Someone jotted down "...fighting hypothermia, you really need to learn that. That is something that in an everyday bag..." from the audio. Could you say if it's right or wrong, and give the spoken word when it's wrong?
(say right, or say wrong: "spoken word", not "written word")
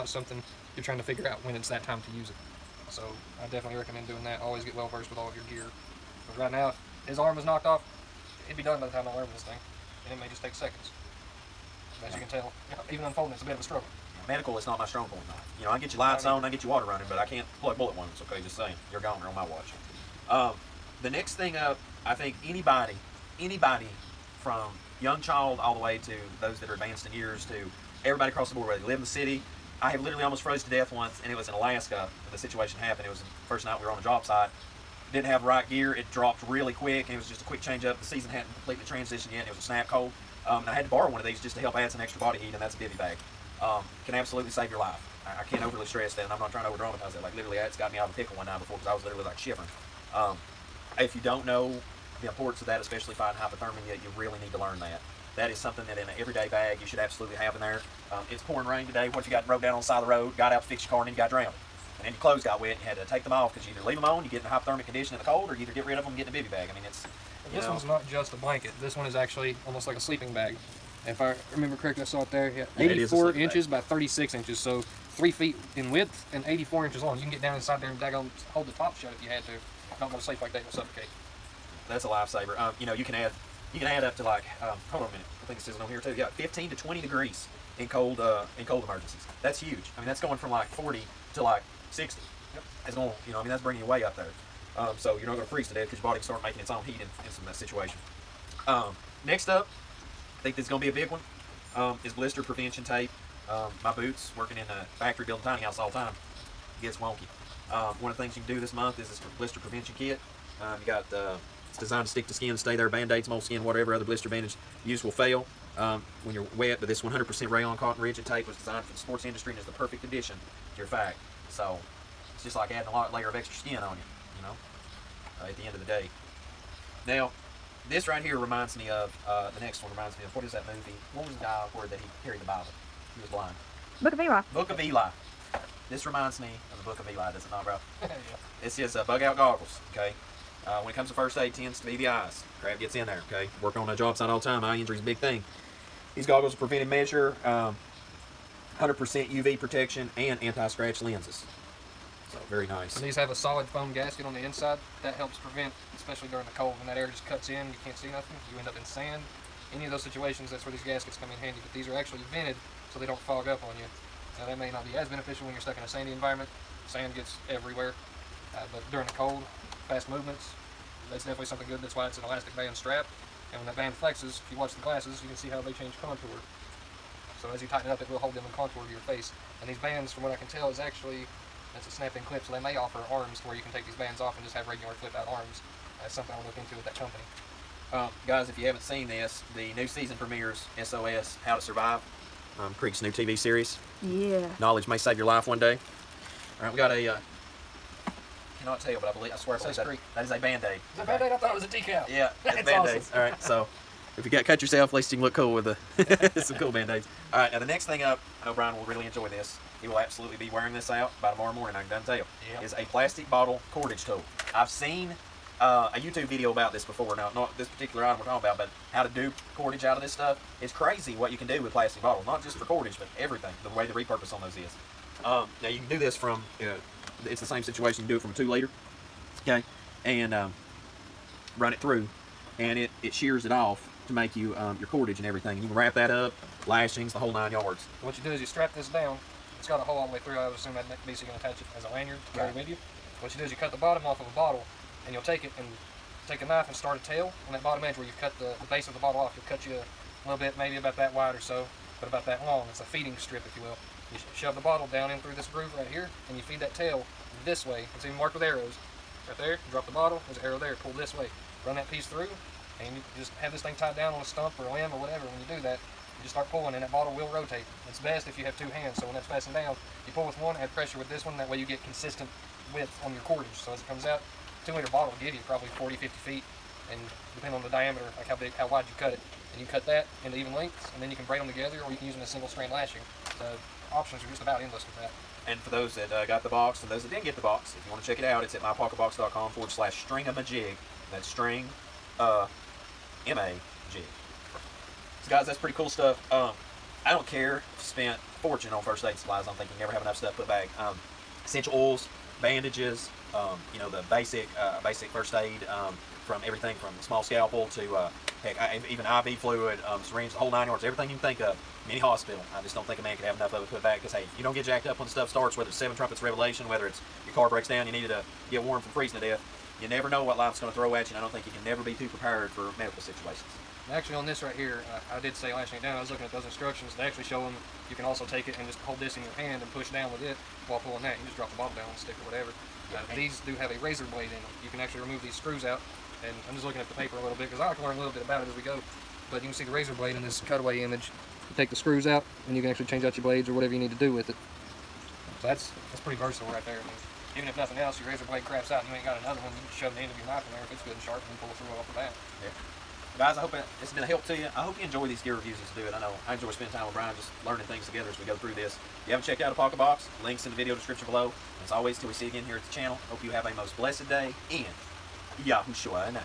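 right.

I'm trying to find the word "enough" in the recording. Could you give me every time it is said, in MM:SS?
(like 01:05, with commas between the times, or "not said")
05:00, 05:13.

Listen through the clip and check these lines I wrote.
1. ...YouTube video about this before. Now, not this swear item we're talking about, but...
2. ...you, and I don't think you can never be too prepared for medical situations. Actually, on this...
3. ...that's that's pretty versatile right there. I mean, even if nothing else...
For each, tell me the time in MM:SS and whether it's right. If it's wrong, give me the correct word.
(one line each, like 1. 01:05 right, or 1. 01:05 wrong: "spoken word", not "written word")
1. 03:35 wrong: "particular", not "swear"
2. 05:21 right
3. 05:45 right.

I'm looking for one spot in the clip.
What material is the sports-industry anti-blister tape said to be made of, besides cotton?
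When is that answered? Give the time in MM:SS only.
01:57.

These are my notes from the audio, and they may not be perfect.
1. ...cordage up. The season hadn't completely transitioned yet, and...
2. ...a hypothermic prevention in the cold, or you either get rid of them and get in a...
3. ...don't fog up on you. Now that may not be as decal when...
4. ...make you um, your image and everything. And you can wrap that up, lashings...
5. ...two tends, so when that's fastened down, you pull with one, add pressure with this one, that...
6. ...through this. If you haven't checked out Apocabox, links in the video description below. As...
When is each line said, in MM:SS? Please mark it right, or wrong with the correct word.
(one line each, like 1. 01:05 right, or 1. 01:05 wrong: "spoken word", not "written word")
1. 00:37 wrong: "change", not "cordage"
2. 01:04 wrong: "condition", not "prevention"
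3. 02:43 wrong: "beneficial", not "decal"
4. 03:54 wrong: "cordage", not "image"
5. 04:28 wrong: "hands", not "tends"
6. 05:58 right.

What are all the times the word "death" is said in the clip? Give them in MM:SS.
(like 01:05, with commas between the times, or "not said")
00:30, 01:35, 05:19.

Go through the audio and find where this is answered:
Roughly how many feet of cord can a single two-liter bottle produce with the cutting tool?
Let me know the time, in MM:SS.
04:35.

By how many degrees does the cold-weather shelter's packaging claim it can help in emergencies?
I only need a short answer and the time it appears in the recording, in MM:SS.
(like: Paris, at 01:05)
15 to 20, at 01:26.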